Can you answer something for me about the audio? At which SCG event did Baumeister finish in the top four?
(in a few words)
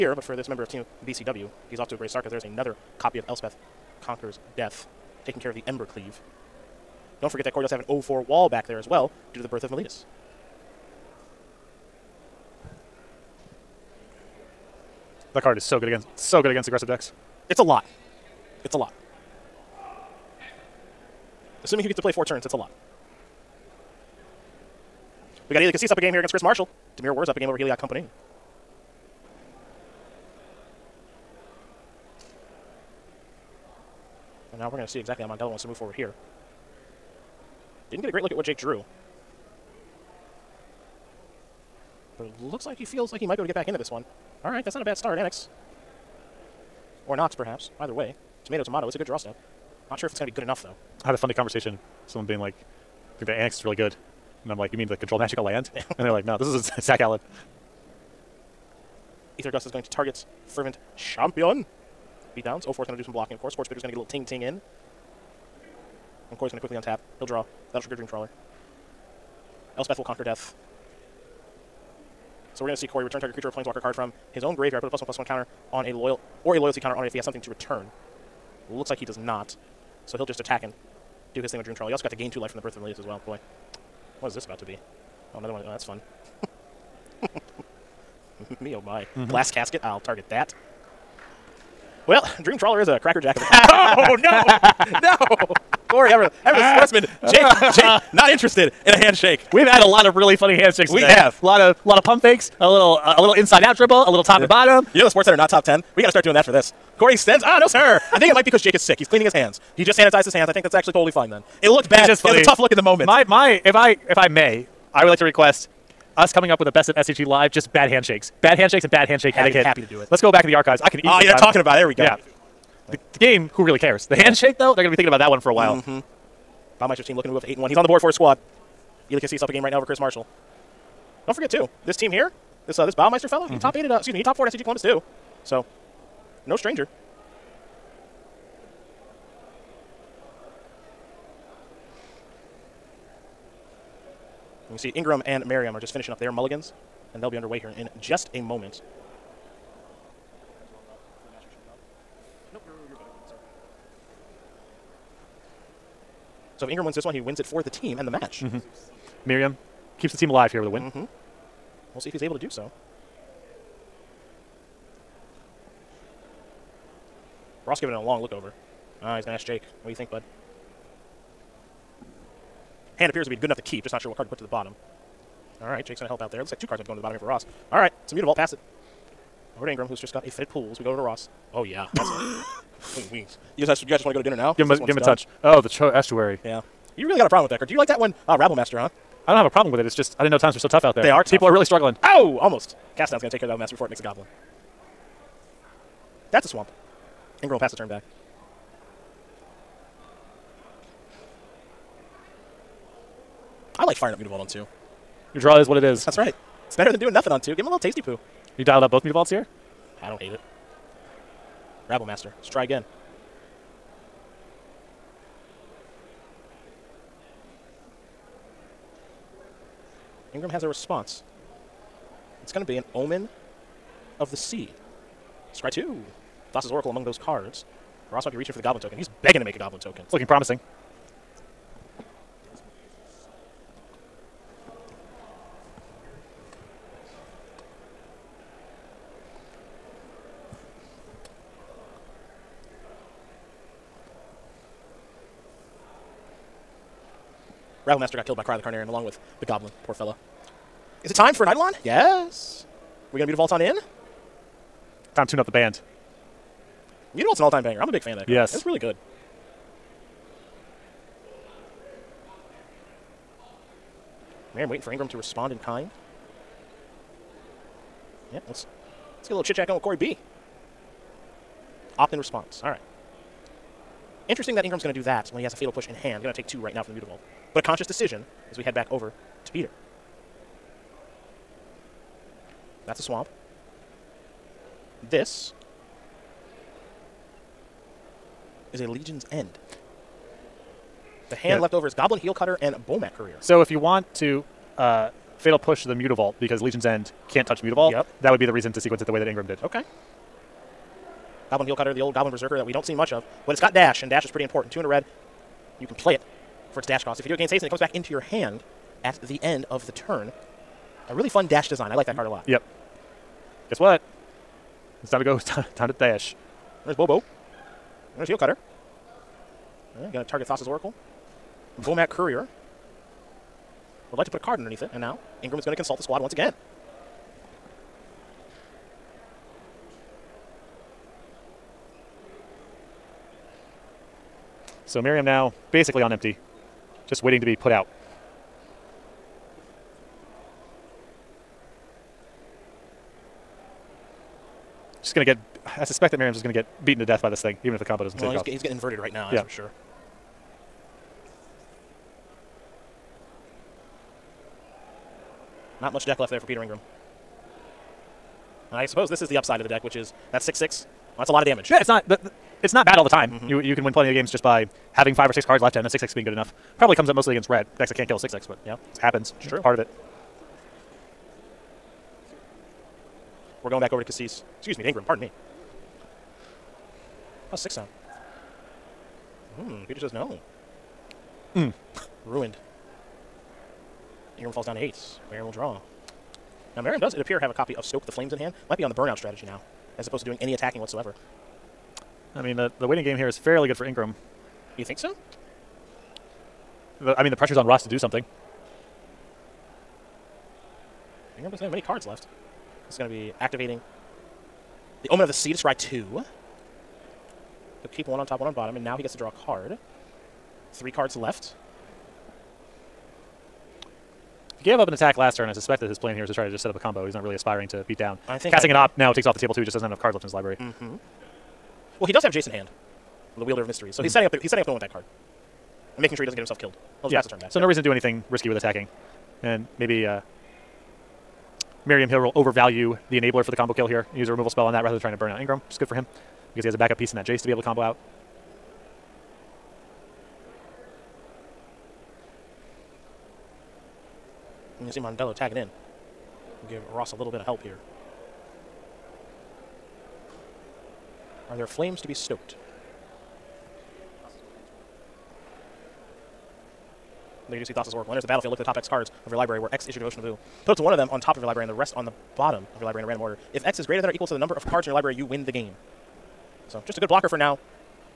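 SCG Columbus.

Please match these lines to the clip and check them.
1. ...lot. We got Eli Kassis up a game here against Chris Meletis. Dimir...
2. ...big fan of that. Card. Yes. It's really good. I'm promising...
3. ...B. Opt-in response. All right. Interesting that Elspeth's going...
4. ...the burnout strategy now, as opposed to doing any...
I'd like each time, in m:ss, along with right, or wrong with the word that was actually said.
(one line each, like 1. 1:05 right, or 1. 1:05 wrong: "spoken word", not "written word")
1. 0:22 wrong: "Marshall", not "Meletis"
2. 4:17 wrong: "waiting", not "promising"
3. 4:29 wrong: "Ingram", not "Elspeth"
4. 6:28 right.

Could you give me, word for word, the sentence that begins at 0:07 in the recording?
Don't forget that Corey does have an 0-4 wall back there as well due to the birth of Meletis.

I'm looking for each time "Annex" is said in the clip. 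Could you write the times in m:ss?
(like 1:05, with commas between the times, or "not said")
0:45, 0:53.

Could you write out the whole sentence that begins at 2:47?
Ross giving it a long look over.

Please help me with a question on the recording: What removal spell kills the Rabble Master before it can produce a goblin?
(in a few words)
Cast Down.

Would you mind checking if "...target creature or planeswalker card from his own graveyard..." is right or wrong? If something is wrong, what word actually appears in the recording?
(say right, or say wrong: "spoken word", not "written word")
right.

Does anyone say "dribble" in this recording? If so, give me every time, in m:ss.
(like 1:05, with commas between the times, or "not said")
1:43.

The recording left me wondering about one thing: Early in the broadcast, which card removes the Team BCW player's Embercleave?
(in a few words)
Elspeth Conquers Death.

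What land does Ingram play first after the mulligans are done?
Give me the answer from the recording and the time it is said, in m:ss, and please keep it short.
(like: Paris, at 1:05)
Fetid Pools, at 3:00.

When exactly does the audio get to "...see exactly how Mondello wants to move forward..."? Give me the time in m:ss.
0:34.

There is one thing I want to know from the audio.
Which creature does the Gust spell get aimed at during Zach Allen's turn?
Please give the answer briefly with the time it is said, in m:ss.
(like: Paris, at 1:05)
Fervent Champion, at 1:00.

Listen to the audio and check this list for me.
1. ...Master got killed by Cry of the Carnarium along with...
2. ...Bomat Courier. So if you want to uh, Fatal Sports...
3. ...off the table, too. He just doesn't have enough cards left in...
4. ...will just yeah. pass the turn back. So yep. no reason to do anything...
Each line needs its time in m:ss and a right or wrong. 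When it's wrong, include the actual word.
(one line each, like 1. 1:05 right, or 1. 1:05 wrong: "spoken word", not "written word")
1. 4:07 right
2. 4:52 wrong: "Push", not "Sports"
3. 6:59 right
4. 7:07 right.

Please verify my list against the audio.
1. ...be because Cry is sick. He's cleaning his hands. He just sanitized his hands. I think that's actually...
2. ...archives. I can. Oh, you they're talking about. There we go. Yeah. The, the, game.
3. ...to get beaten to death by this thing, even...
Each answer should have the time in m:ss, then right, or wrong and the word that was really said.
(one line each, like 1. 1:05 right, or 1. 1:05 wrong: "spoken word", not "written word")
1. 1:48 wrong: "Jake", not "Cry"
2. 2:00 right
3. 5:46 right.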